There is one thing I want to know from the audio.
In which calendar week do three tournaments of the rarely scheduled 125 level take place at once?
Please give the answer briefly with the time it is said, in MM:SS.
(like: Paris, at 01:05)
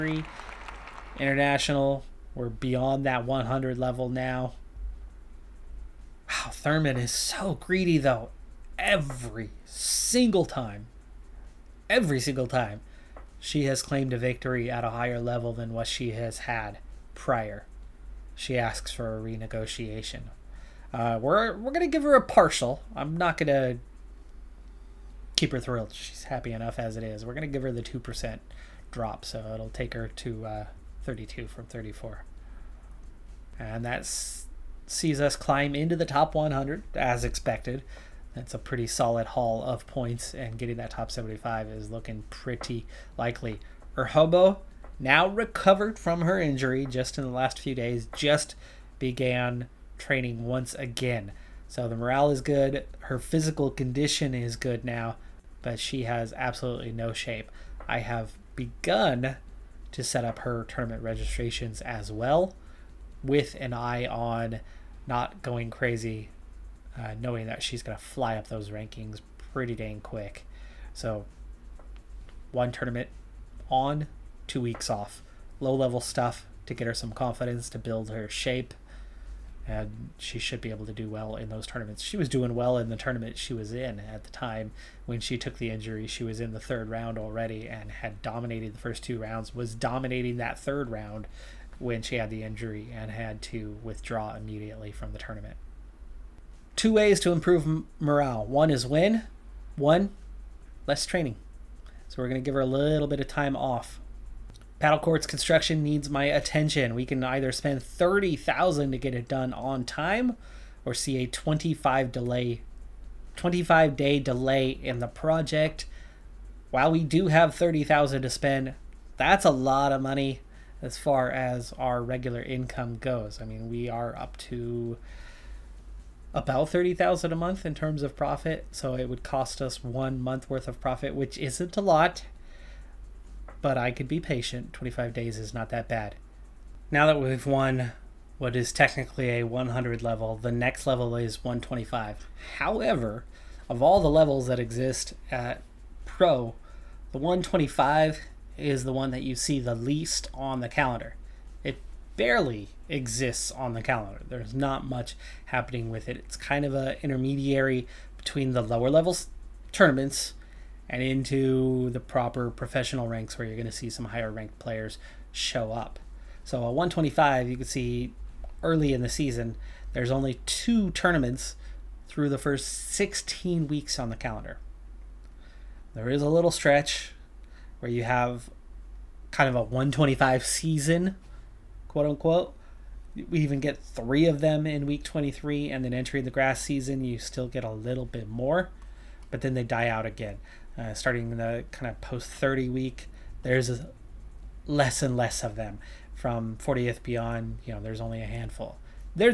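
Week 23, at 03:04.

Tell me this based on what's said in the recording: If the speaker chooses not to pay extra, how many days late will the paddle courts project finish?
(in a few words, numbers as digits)
25 days.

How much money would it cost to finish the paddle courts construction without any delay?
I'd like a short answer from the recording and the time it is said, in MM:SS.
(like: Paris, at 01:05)
30,000, at 01:47.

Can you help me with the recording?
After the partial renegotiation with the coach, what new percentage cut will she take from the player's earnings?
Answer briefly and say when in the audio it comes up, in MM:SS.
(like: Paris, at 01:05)
32, at 00:31.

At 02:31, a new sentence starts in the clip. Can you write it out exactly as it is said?
It barely exists on the calendar.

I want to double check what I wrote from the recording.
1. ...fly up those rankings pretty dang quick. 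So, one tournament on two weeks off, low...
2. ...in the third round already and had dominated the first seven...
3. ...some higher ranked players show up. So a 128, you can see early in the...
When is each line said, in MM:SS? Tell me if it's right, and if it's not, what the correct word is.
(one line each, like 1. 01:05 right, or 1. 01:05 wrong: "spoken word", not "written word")
1. 01:08 right
2. 01:26 wrong: "two", not "seven"
3. 02:43 wrong: "125", not "128".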